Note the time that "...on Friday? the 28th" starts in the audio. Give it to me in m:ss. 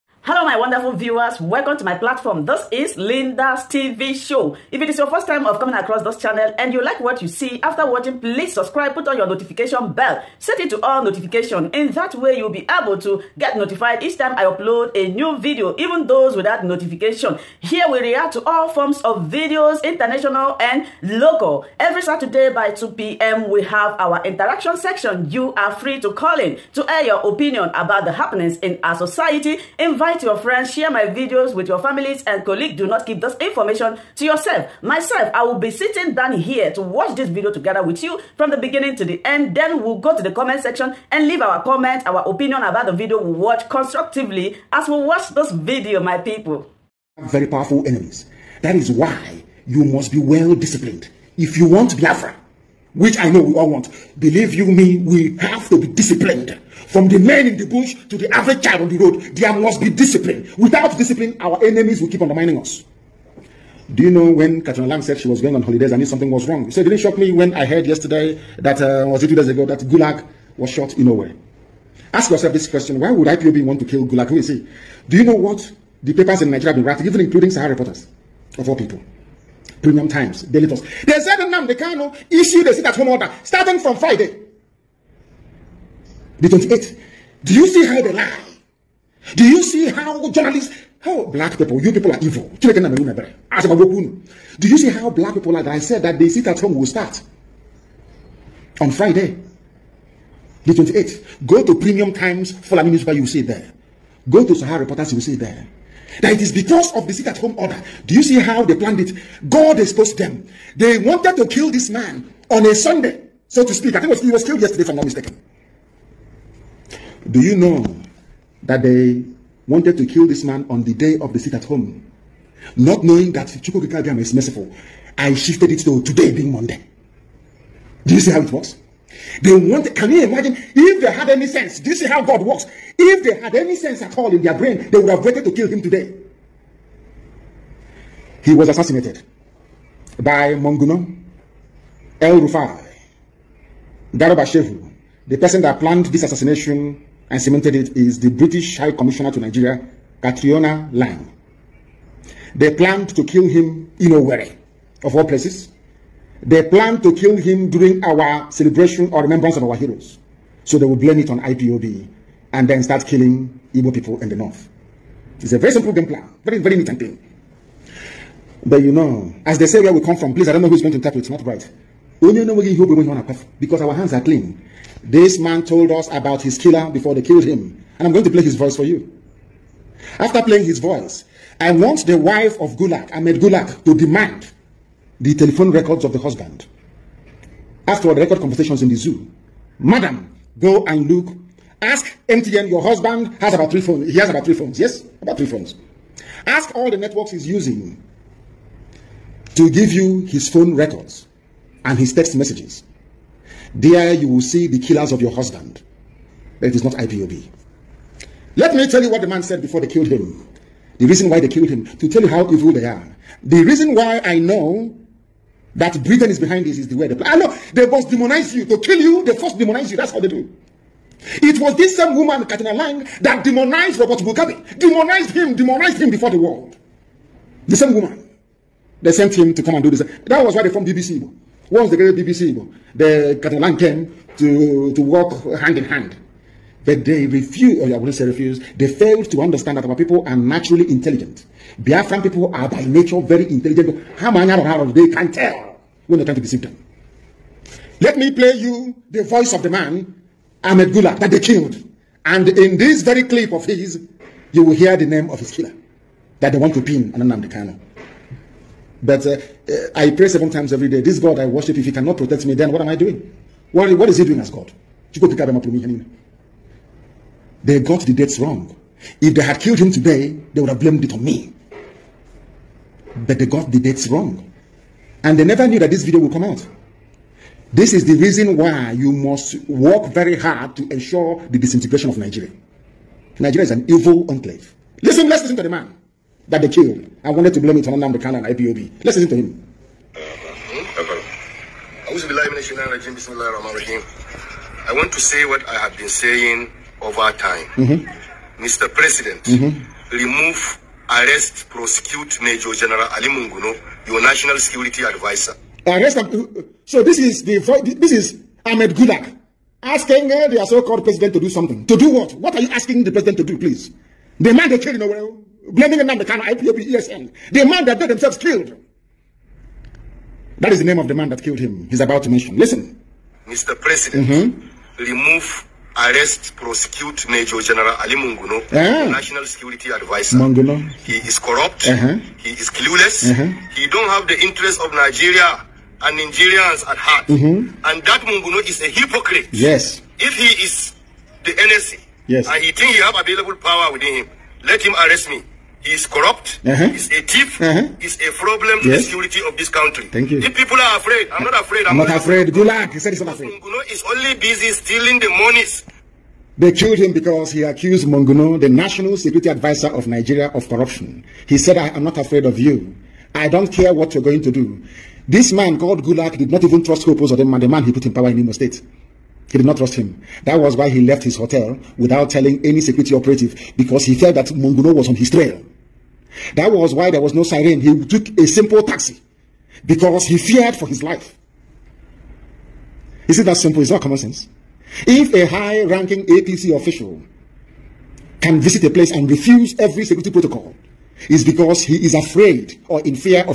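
1:38.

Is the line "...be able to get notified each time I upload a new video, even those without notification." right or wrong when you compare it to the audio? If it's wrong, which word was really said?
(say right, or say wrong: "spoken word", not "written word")
right.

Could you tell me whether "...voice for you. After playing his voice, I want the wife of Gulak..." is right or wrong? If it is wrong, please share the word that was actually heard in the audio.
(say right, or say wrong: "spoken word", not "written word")
right.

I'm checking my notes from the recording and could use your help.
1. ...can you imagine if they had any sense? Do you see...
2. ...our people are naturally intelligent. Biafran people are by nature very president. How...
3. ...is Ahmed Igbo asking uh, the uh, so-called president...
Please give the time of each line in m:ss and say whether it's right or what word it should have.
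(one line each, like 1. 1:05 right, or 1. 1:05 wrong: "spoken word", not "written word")
1. 2:09 right
2. 3:59 wrong: "intelligent", not "president"
3. 5:08 wrong: "Gulak", not "Igbo".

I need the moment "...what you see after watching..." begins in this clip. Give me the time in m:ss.
0:06.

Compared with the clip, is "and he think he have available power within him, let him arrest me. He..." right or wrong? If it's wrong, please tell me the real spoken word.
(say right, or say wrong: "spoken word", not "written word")
right.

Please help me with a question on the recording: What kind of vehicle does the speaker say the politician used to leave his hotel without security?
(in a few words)
a simple taxi.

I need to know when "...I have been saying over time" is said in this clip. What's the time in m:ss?
4:55.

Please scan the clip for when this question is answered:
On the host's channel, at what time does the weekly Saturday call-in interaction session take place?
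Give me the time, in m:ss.
0:22.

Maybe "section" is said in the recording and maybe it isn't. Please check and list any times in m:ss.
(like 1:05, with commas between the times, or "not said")
0:24, 0:40.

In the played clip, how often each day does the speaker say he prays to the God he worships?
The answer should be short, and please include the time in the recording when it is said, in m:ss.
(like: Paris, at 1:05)
seven times, at 4:20.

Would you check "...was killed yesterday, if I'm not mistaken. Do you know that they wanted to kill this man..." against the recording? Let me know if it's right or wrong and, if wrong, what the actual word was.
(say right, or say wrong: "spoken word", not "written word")
right.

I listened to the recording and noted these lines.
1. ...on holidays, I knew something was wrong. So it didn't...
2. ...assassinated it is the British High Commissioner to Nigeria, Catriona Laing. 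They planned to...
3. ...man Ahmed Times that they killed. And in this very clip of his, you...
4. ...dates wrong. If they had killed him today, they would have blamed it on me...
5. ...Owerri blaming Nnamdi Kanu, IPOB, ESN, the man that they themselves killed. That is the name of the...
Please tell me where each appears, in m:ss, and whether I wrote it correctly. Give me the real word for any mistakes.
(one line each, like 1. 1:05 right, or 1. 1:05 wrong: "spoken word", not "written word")
1. 1:05 right
2. 2:27 wrong: "cemented", not "assassinated"
3. 4:09 wrong: "Gulak", not "Times"
4. 4:28 right
5. 5:15 right.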